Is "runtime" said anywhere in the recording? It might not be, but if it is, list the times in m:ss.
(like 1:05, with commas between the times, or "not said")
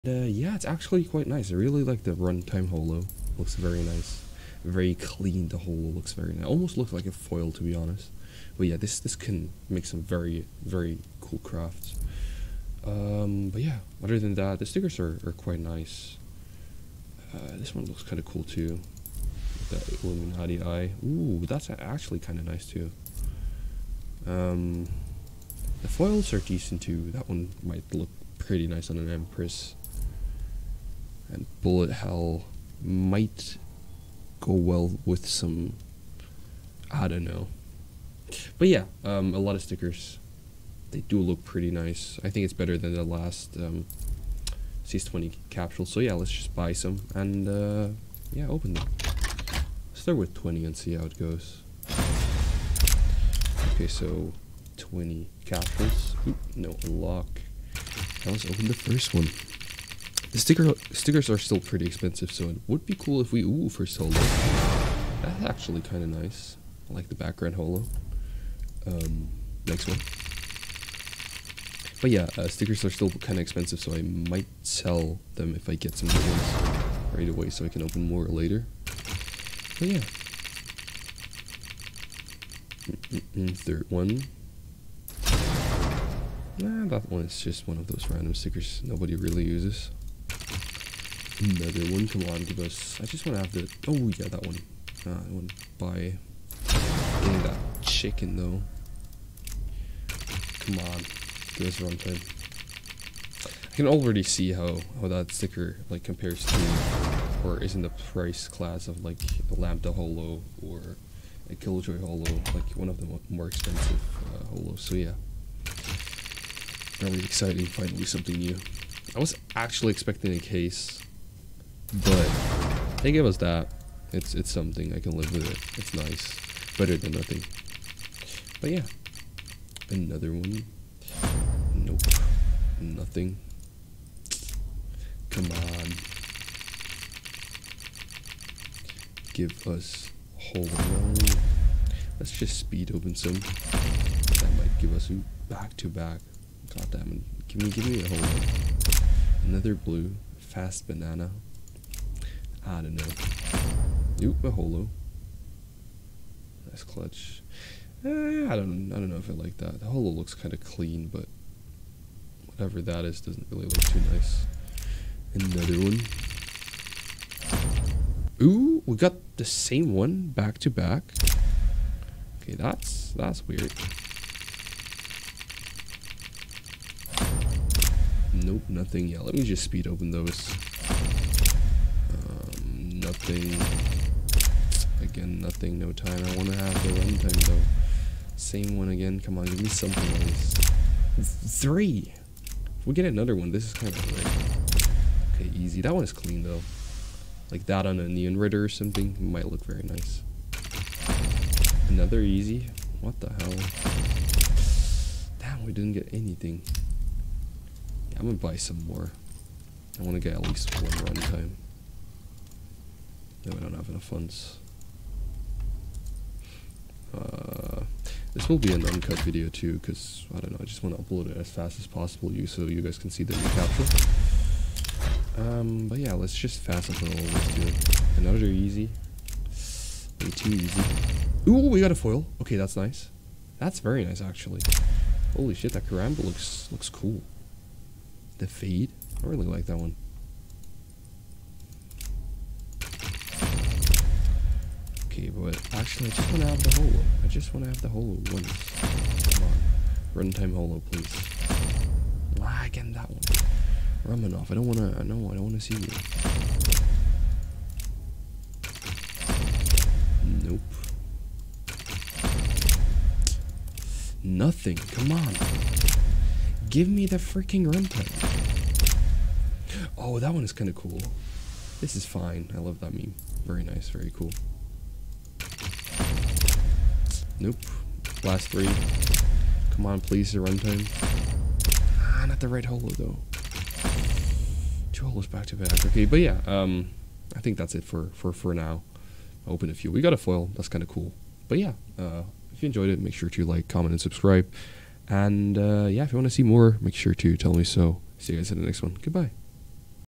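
0:02, 3:06, 3:30, 4:10, 4:27, 4:40.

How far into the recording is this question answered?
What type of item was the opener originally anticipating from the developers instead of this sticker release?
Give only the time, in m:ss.
2:00.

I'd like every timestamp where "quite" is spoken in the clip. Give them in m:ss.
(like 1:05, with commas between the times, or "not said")
0:01, 0:15.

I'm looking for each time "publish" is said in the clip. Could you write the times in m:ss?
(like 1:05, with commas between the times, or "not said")
not said.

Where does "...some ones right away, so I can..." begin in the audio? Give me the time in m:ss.
1:15.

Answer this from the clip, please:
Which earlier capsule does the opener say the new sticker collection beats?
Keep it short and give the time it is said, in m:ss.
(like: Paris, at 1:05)
CS20 capsule, at 0:44.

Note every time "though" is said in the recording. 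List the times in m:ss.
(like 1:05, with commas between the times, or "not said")
1:38, 3:07, 3:16, 4:42.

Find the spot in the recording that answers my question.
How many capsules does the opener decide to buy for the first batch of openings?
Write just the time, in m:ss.
0:49.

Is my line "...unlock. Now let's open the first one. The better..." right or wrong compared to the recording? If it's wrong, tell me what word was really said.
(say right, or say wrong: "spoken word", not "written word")
wrong: "sticker", not "better".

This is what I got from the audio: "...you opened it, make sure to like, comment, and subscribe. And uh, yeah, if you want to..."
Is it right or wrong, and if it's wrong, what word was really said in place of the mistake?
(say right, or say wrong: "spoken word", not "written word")
wrong: "enjoyed", not "opened".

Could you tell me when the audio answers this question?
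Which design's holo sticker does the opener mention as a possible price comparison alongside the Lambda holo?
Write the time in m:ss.
1:51.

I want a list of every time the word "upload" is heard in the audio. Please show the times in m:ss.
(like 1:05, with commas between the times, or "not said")
3:41, 3:46.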